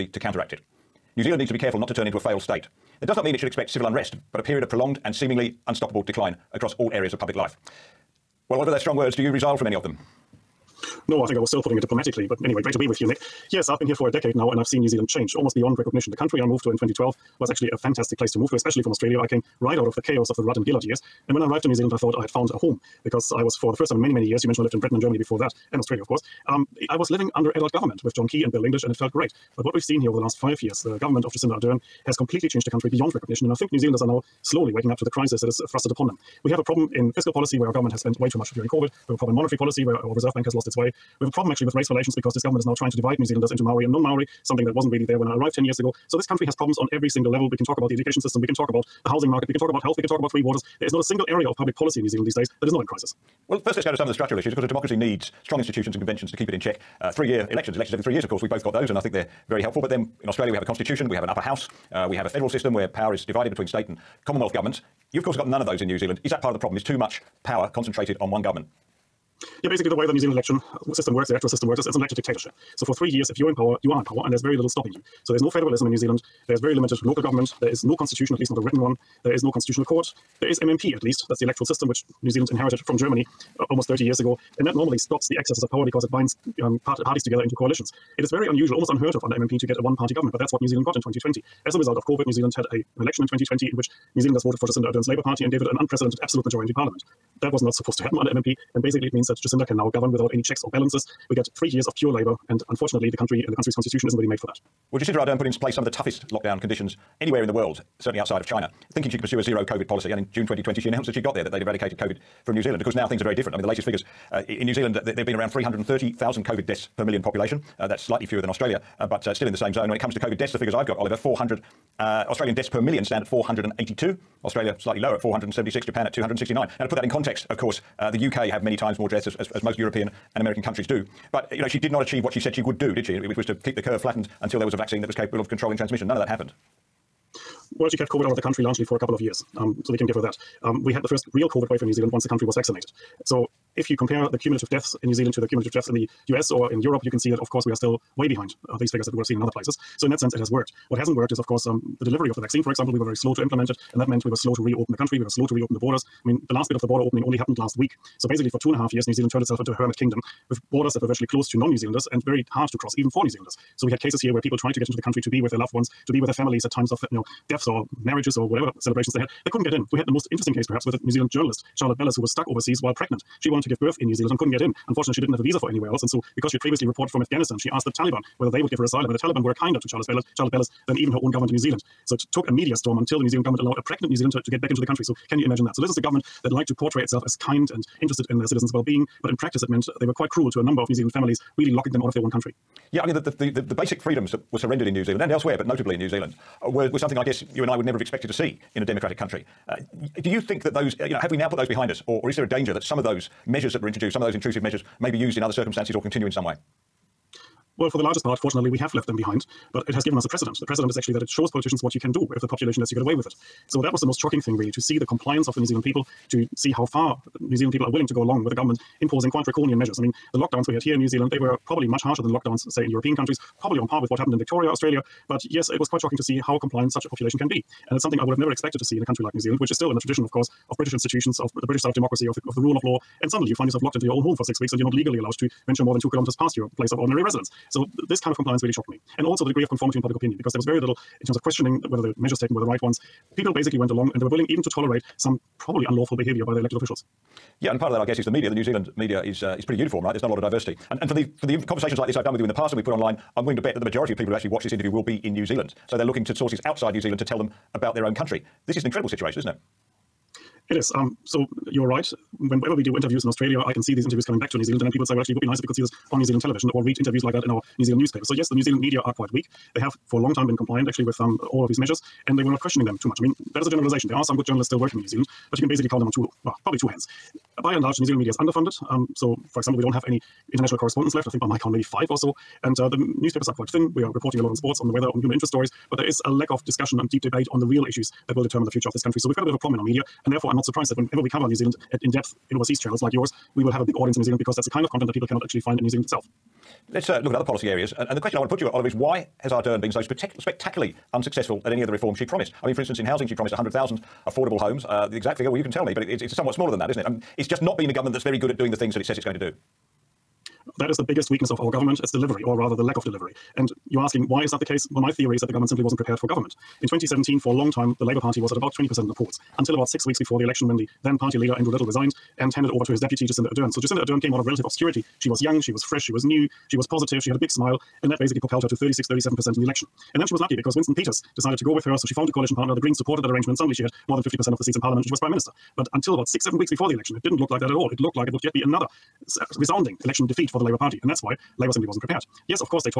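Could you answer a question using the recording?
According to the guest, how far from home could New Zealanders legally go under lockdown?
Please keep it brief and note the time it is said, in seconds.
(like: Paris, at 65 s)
2 kilometers, at 235 s.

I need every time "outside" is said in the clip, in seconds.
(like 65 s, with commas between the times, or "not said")
108 s, 256 s.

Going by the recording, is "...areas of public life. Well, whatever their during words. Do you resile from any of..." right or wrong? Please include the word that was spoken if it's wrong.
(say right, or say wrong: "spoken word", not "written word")
wrong: "strong", not "during".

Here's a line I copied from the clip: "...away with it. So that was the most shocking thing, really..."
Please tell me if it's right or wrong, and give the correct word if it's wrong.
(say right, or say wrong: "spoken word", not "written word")
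right.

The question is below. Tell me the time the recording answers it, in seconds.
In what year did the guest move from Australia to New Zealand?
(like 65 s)
16 s.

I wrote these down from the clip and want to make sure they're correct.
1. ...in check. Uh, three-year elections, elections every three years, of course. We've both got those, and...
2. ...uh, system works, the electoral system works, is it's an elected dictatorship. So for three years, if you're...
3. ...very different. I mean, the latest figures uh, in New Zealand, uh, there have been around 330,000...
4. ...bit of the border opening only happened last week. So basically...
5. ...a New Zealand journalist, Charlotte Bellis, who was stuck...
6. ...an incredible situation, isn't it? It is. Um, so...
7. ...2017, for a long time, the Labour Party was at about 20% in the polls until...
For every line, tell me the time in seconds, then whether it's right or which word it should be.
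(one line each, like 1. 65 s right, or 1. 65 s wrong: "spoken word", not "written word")
1. 56 s right
2. 70 s right
3. 113 s right
4. 156 s right
5. 170 s right
6. 258 s right
7. 316 s right.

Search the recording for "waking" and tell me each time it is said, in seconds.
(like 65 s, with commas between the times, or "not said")
34 s.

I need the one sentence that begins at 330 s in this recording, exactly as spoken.
And then she was lucky because Winston Peters decided to go with her.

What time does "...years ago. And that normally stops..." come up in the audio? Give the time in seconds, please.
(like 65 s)
84 s.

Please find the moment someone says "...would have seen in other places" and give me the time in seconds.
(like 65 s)
149 s.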